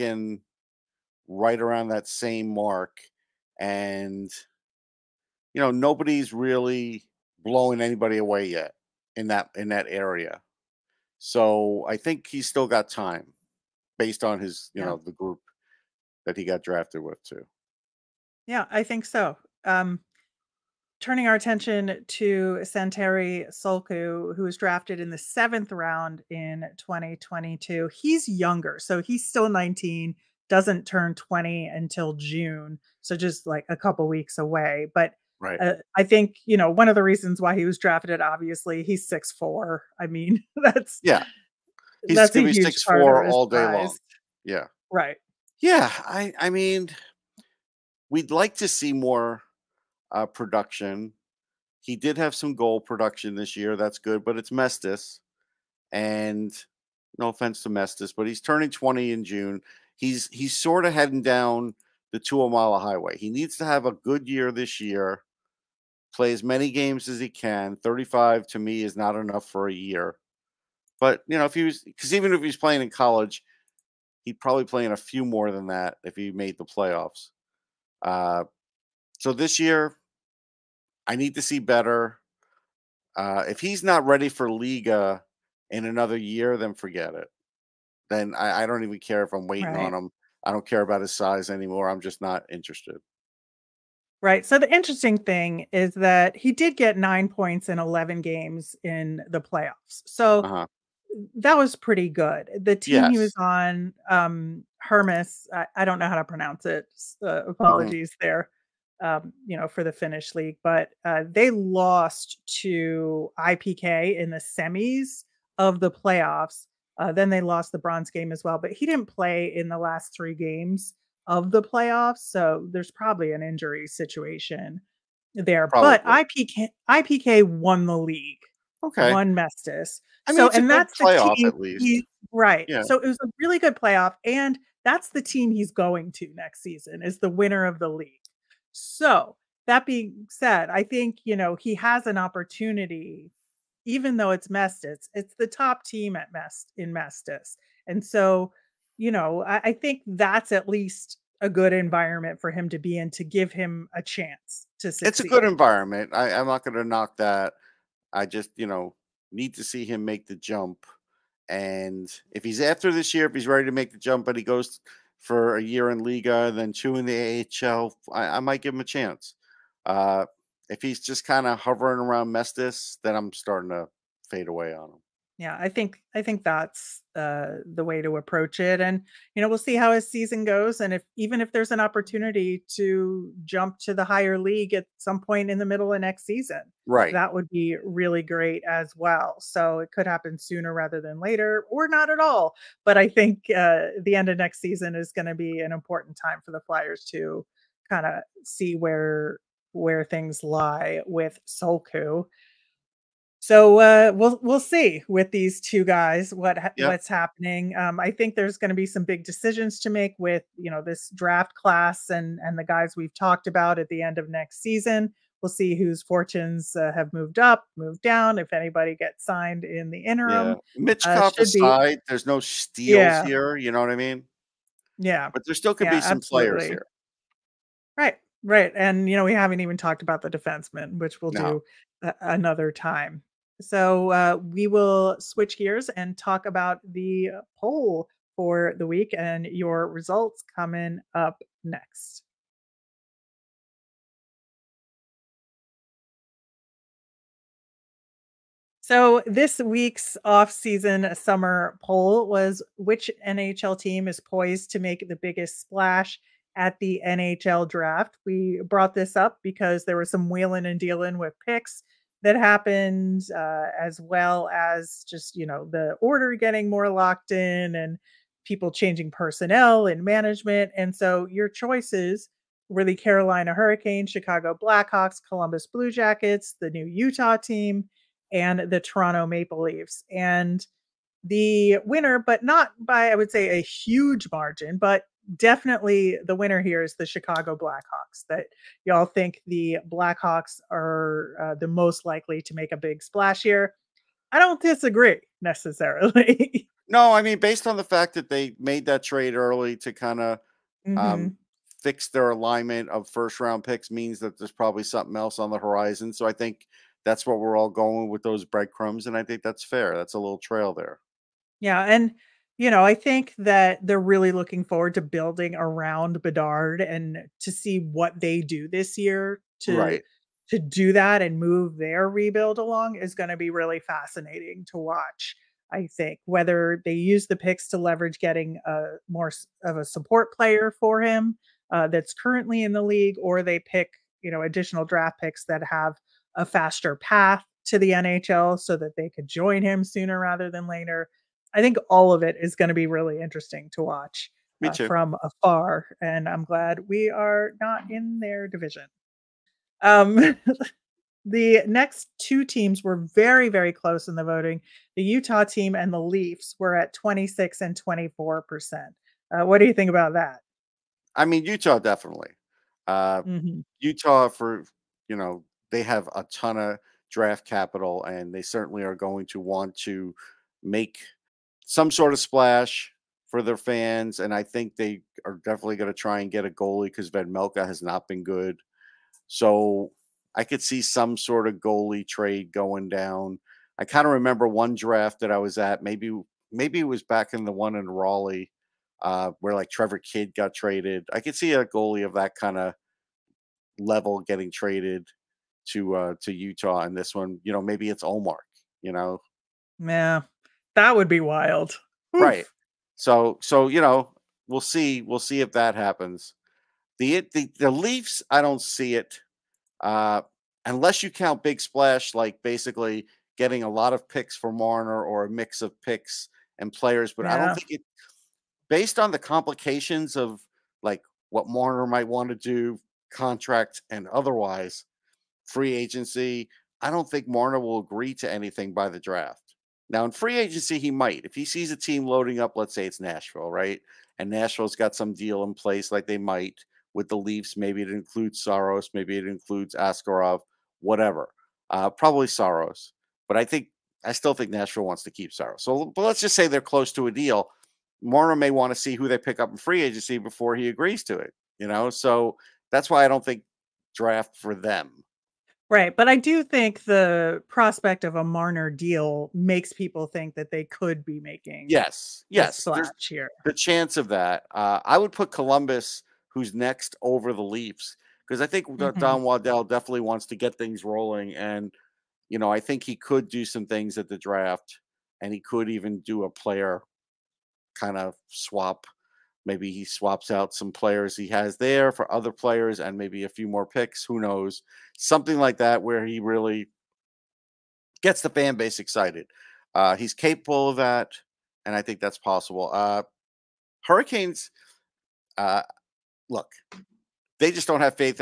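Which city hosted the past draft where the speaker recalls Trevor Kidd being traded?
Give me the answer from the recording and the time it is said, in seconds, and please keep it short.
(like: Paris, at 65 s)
Raleigh, at 387 s.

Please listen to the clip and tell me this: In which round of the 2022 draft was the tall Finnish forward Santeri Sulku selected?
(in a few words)
seventh.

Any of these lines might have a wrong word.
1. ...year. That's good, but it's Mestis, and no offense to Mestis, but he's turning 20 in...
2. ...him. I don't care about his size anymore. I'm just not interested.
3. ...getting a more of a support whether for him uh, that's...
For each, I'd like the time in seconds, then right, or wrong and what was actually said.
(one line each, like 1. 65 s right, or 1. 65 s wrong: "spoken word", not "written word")
1. 53 s right
2. 89 s right
3. 328 s wrong: "player", not "whether".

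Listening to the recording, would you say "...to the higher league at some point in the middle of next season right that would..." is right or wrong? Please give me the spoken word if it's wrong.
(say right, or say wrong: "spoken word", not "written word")
right.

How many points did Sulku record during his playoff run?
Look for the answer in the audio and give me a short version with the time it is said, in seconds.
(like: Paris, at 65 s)
nine, at 96 s.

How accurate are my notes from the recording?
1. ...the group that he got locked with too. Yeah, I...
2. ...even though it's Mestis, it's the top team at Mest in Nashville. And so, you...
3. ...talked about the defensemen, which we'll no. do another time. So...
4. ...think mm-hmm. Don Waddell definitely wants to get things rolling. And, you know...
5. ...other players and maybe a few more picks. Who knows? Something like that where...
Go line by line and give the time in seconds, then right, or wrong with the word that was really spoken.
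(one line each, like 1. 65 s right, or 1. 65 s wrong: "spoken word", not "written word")
1. 15 s wrong: "drafted", not "locked"
2. 143 s wrong: "Mestis", not "Nashville"
3. 229 s right
4. 468 s right
5. 482 s right.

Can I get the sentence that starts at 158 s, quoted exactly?
I just, you know, need to see him make the jump.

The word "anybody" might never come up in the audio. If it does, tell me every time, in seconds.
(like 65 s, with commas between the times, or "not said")
7 s, 218 s.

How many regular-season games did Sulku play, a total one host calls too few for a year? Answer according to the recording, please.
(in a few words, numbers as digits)
35.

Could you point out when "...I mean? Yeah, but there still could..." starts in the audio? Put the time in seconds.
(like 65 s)
223 s.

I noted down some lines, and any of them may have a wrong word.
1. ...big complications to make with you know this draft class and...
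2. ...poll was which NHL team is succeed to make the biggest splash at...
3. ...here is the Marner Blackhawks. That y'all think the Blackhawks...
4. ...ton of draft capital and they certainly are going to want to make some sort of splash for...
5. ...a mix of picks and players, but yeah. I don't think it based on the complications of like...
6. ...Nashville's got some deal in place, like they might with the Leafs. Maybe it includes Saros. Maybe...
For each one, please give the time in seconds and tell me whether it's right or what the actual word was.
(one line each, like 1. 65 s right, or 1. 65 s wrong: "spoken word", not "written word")
1. 209 s wrong: "decisions", not "complications"
2. 251 s wrong: "poised", not "succeed"
3. 286 s wrong: "Chicago", not "Marner"
4. 366 s right
5. 415 s right
6. 434 s right.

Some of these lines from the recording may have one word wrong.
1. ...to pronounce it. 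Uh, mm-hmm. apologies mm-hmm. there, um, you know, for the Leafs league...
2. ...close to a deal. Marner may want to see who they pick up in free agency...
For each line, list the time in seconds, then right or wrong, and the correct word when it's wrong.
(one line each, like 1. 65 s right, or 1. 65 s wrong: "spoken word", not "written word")
1. 106 s wrong: "Finnish", not "Leafs"
2. 446 s right.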